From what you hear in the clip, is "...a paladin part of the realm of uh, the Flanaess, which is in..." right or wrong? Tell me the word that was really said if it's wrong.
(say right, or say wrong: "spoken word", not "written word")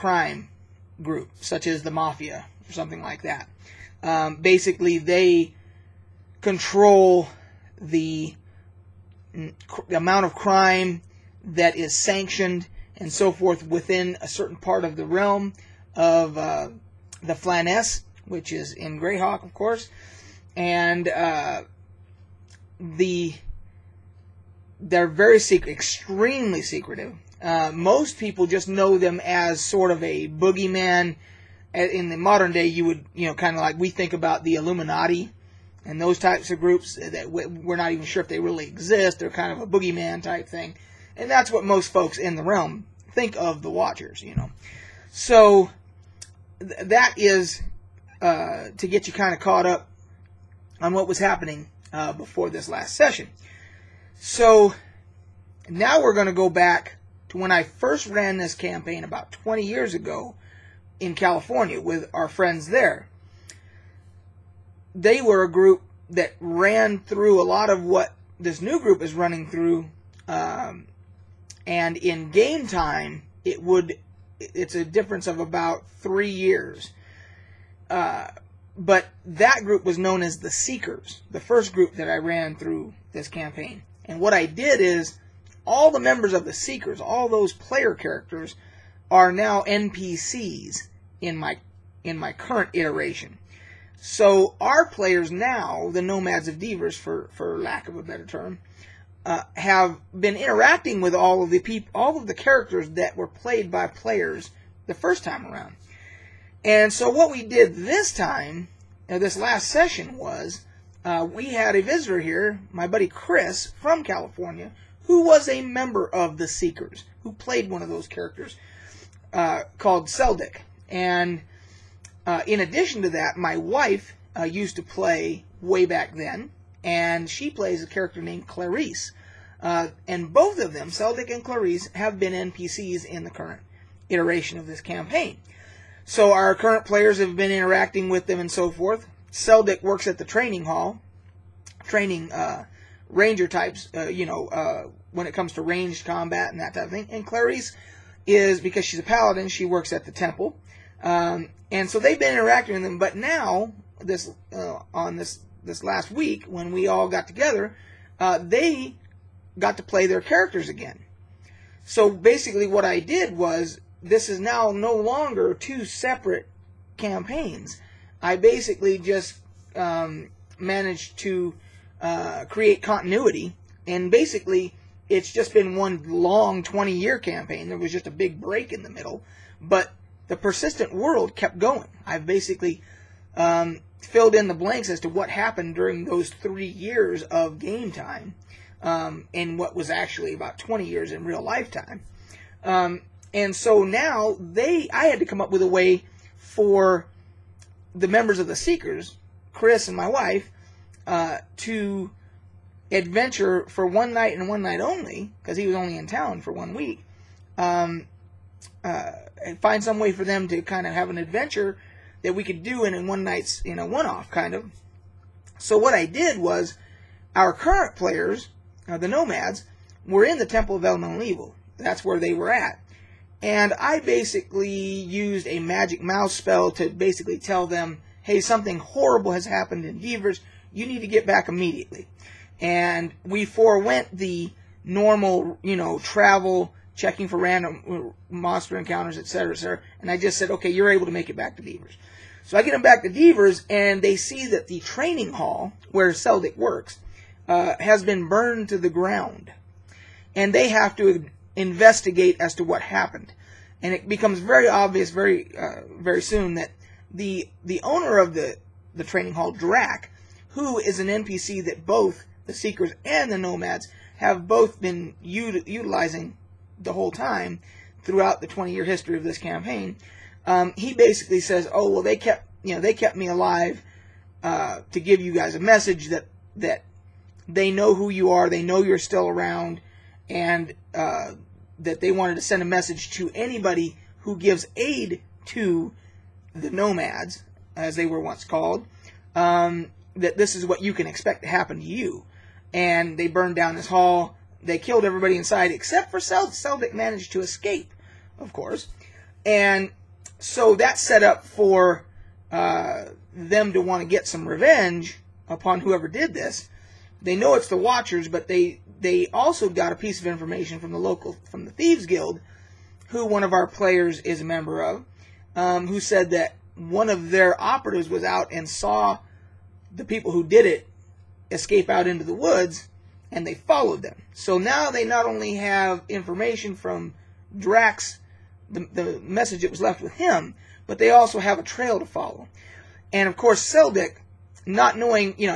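wrong: "certain", not "paladin".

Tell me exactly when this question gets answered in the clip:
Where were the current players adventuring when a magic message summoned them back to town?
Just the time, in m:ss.
3:40.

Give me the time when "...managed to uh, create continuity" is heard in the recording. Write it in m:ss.
2:50.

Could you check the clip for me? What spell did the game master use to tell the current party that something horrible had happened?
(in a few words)
magic mouth.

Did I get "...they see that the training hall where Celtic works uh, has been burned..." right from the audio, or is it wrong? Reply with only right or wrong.
right.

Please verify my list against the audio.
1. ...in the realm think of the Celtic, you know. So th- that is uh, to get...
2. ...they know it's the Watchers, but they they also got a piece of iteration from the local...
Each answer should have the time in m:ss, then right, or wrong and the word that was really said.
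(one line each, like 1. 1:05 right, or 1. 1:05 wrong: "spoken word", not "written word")
1. 0:42 wrong: "Watchers", not "Celtic"
2. 5:07 wrong: "information", not "iteration".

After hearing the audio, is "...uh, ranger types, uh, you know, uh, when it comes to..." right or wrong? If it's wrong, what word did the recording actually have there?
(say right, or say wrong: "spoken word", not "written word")
right.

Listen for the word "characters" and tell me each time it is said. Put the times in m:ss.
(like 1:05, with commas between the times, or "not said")
1:27, 1:42, 1:58, 2:07, 2:40.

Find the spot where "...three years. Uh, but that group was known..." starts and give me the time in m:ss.
1:15.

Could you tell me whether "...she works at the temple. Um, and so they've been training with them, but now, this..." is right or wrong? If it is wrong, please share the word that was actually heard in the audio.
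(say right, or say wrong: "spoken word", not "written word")
wrong: "interacting", not "training".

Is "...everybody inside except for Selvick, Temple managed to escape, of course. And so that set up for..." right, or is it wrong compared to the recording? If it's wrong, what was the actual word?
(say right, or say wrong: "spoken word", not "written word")
wrong: "Selvik", not "Temple".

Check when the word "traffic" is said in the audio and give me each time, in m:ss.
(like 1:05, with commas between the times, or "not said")
not said.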